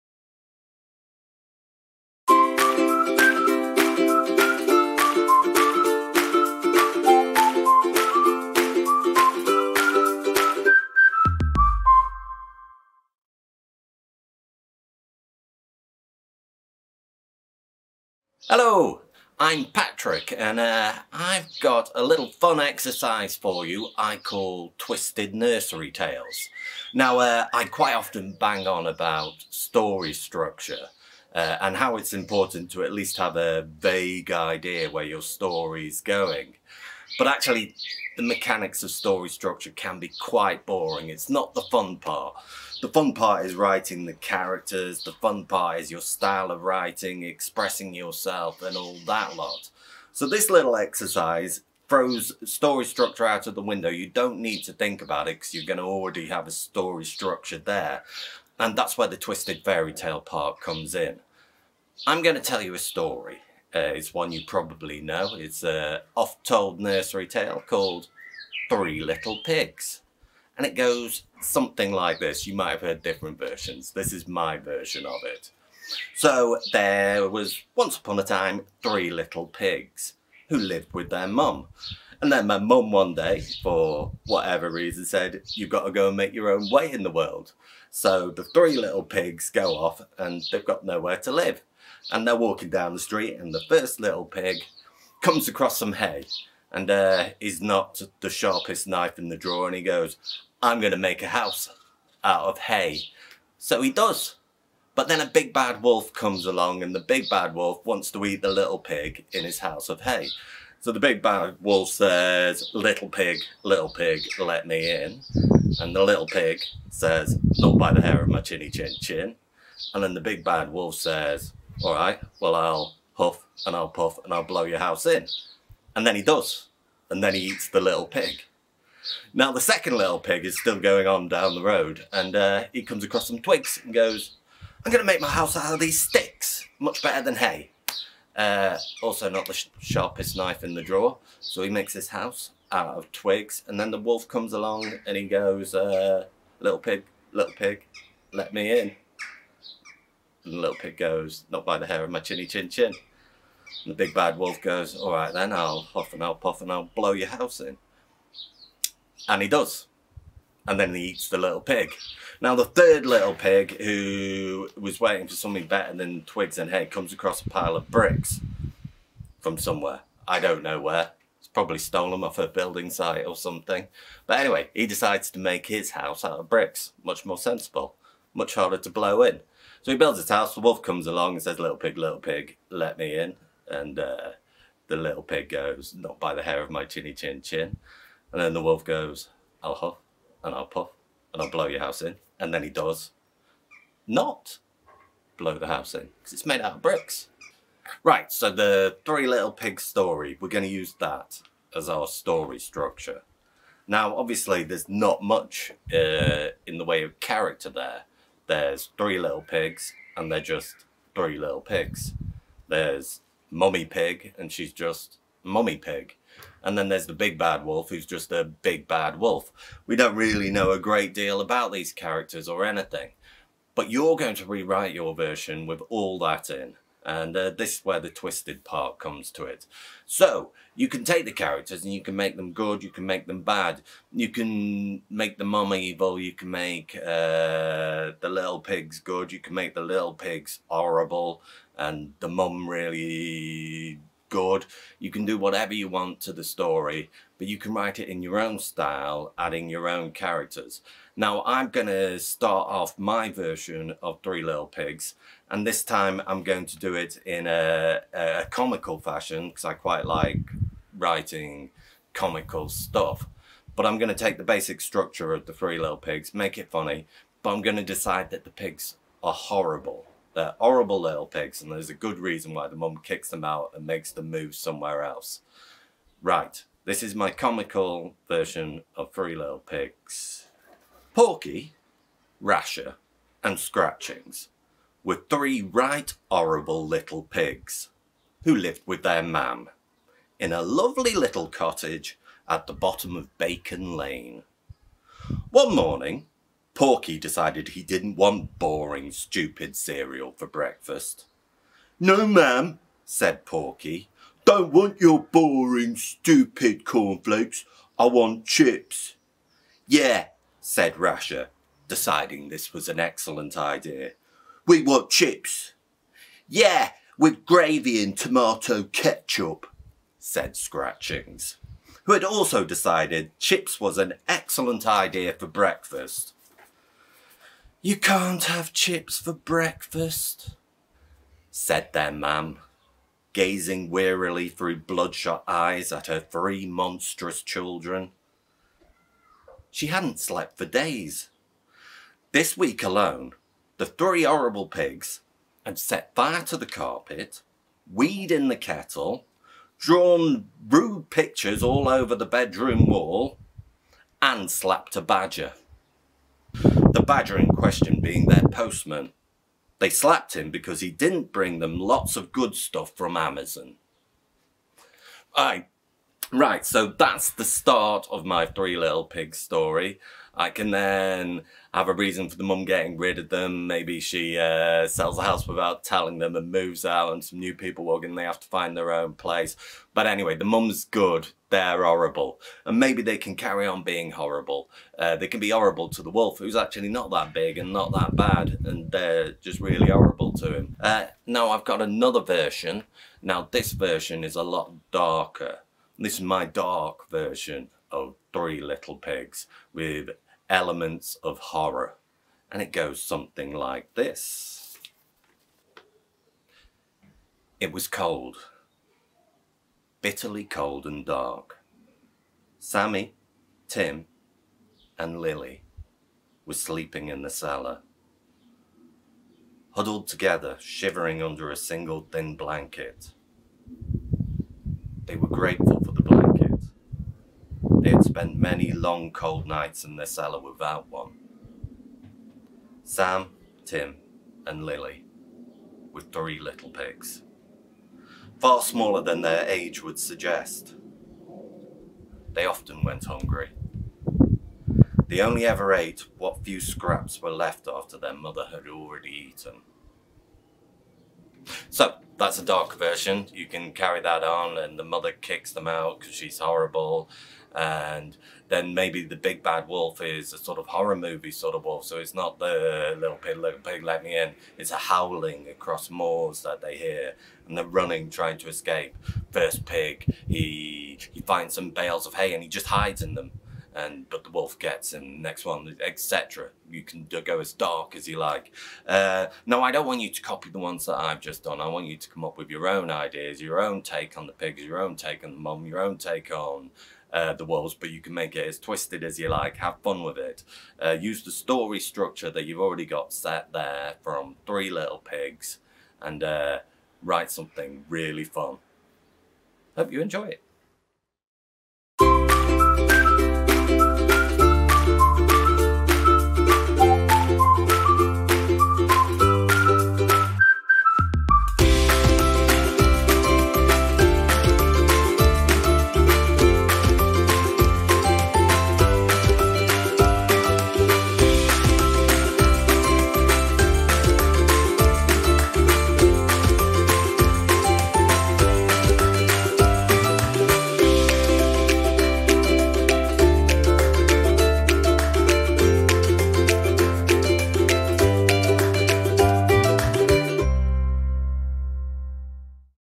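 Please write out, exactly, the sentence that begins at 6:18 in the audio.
They have to find their own place.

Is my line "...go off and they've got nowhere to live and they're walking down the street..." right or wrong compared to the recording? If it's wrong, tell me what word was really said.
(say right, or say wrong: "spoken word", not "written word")
right.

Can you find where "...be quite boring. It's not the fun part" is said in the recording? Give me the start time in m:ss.
0:39.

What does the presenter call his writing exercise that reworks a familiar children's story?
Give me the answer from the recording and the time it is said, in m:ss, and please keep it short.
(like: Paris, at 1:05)
Twisted Nursery Tales, at 0:24.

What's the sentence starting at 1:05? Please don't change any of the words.
It's a oft-told nursery tale called Three Little Pigs.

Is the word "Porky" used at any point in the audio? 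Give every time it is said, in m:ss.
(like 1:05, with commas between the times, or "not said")
4:41, 4:56, 5:03.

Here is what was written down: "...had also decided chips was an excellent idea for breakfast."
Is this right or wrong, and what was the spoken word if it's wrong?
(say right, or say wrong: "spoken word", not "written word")
right.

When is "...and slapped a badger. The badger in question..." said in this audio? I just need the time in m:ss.
5:54.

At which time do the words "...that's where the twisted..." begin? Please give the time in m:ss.
0:58.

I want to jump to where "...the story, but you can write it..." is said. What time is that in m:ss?
4:06.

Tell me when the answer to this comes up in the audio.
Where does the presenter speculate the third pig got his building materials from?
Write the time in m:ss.
2:52.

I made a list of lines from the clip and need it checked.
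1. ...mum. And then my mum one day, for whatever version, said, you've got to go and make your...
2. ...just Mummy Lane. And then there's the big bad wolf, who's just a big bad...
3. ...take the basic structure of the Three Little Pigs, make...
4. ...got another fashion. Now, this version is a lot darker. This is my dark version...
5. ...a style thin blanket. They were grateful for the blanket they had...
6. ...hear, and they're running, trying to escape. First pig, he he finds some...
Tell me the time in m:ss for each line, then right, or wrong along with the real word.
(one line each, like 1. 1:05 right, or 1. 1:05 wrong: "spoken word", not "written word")
1. 1:21 wrong: "reason", not "version"
2. 3:34 wrong: "Pig", not "Lane"
3. 4:24 right
4. 6:31 wrong: "version", not "fashion"
5. 7:01 wrong: "single", not "style"
6. 7:46 right.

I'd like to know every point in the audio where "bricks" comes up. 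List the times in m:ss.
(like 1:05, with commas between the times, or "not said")
2:47, 2:56, 3:16.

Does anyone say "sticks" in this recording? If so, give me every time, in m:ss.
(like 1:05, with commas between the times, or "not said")
2:15.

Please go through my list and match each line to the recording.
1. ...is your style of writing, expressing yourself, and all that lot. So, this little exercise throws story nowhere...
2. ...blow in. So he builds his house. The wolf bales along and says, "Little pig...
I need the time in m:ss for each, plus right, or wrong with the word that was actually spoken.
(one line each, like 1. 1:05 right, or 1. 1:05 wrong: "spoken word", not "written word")
1. 0:45 wrong: "structure", not "nowhere"
2. 2:58 wrong: "comes", not "bales".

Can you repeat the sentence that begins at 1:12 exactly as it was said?
You might have heard different versions.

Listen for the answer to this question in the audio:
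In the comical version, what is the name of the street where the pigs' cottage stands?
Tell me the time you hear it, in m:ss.
4:53.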